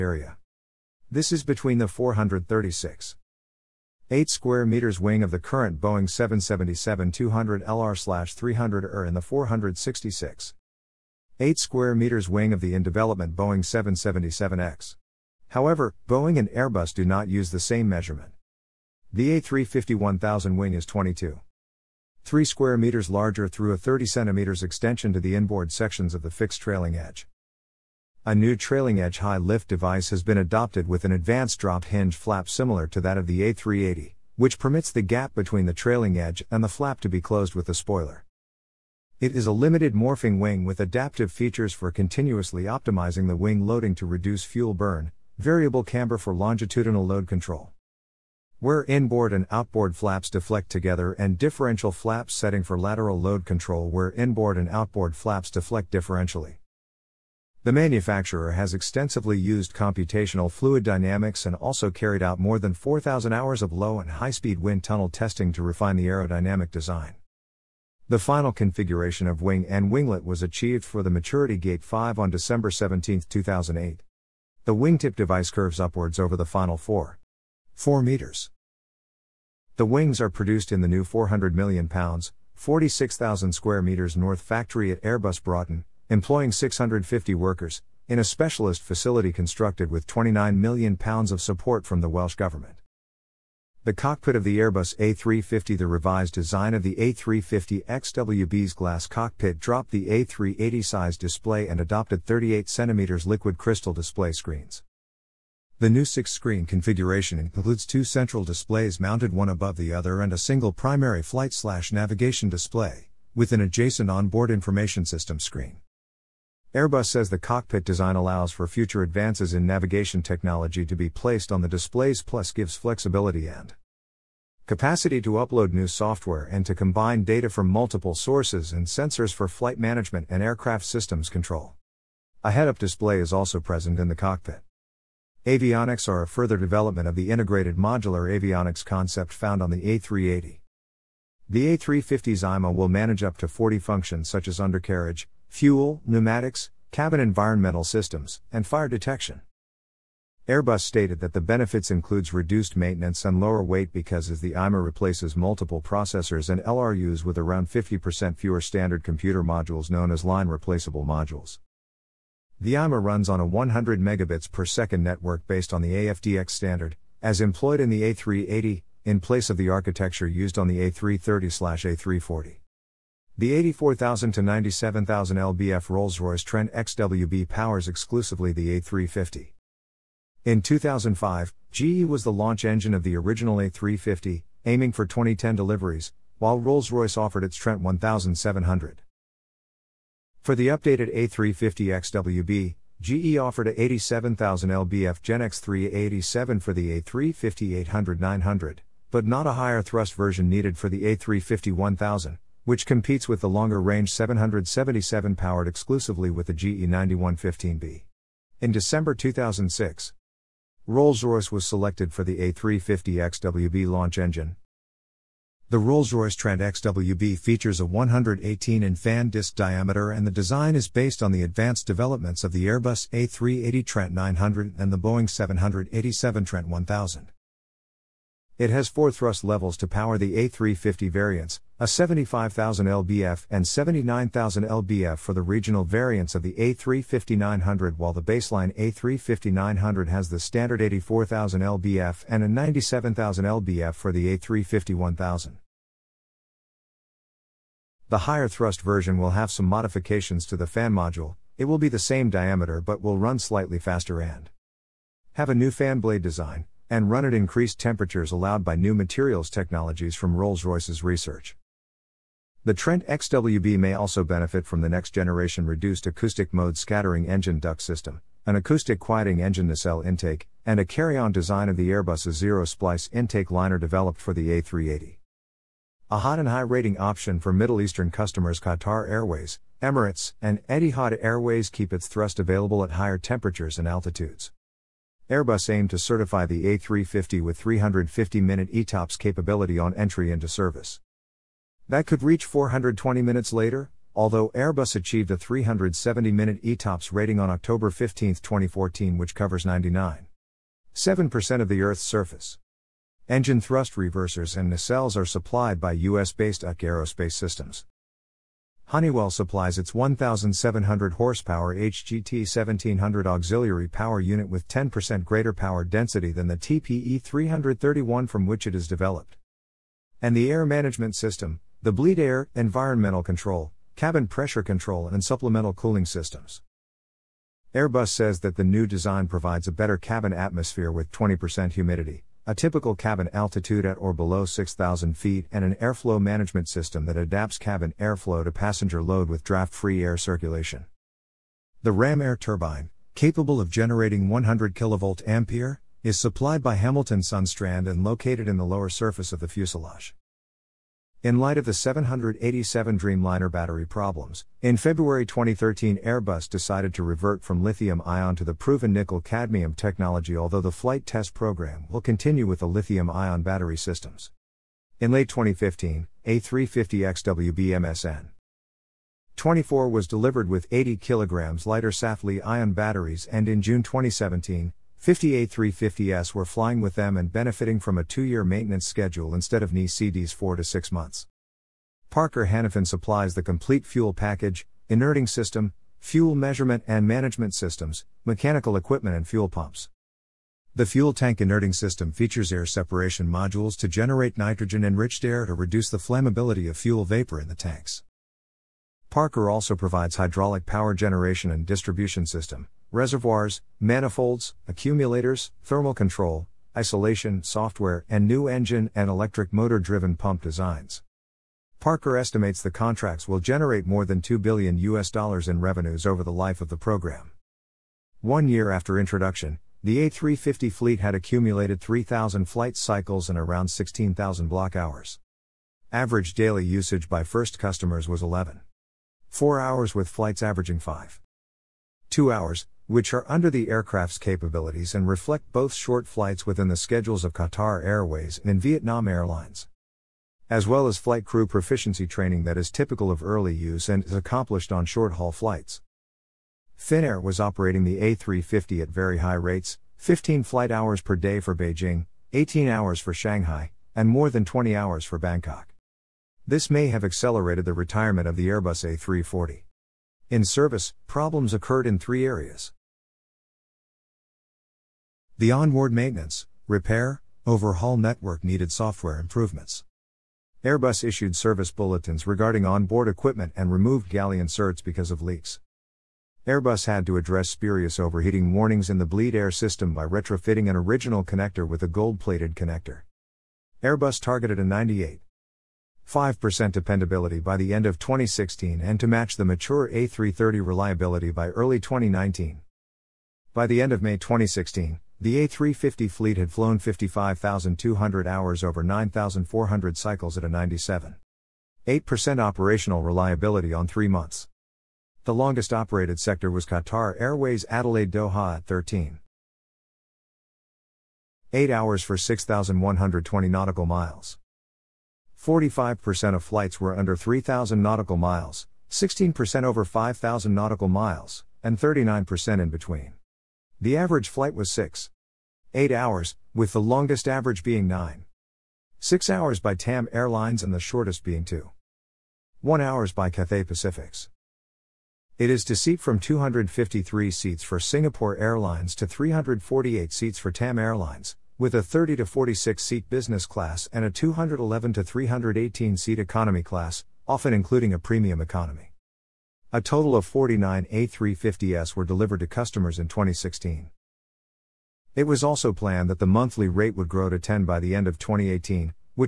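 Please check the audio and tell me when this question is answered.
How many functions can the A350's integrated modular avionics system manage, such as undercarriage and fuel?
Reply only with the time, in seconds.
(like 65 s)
143 s.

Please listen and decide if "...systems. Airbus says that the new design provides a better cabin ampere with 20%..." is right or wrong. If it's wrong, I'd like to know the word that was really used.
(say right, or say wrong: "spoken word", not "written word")
wrong: "atmosphere", not "ampere".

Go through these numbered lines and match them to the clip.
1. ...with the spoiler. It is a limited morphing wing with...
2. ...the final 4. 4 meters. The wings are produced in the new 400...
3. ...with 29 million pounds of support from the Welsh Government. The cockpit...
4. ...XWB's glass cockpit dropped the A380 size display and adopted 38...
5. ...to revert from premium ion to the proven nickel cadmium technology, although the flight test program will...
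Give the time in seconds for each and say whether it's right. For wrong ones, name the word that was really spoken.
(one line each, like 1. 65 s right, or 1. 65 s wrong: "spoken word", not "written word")
1. 37 s right
2. 76 s right
3. 89 s right
4. 97 s right
5. 356 s wrong: "lithium", not "premium".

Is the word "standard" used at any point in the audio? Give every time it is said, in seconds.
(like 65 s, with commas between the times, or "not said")
158 s, 166 s, 240 s.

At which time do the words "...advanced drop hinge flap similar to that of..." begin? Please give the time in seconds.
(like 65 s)
31 s.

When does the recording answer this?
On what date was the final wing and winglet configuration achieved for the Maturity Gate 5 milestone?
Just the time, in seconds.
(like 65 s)
72 s.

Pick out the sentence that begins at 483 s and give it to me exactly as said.
Airbus targeted a 98 5% dependability by the end of 2016 and to match the mature A330 reliability by early 2019.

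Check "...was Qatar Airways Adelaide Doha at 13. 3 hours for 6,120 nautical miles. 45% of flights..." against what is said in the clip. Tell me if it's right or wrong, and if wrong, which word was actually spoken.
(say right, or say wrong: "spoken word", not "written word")
wrong: "8", not "3".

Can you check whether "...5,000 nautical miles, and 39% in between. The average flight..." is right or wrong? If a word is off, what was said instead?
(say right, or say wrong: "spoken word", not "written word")
right.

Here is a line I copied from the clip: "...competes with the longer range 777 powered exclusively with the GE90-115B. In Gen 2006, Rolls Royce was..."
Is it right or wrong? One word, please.
wrong.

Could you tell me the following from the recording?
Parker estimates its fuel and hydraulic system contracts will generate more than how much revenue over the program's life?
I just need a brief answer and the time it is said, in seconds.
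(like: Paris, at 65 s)
2 billion US dollars, at 414 s.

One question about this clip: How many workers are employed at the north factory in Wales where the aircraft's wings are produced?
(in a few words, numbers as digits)
650.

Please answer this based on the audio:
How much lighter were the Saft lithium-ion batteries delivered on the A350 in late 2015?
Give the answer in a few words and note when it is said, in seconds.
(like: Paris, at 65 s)
80 kg, at 370 s.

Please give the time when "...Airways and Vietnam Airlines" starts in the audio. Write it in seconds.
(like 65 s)
437 s.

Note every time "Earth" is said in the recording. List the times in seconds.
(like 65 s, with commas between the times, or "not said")
301 s.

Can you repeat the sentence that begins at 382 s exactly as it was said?
Parker Hannifin supplies the complete fuel package, inerting system, fuel measurement and management systems, mechanical equipment, and fuel pumps.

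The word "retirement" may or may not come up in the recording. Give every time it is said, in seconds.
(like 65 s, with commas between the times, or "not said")
457 s.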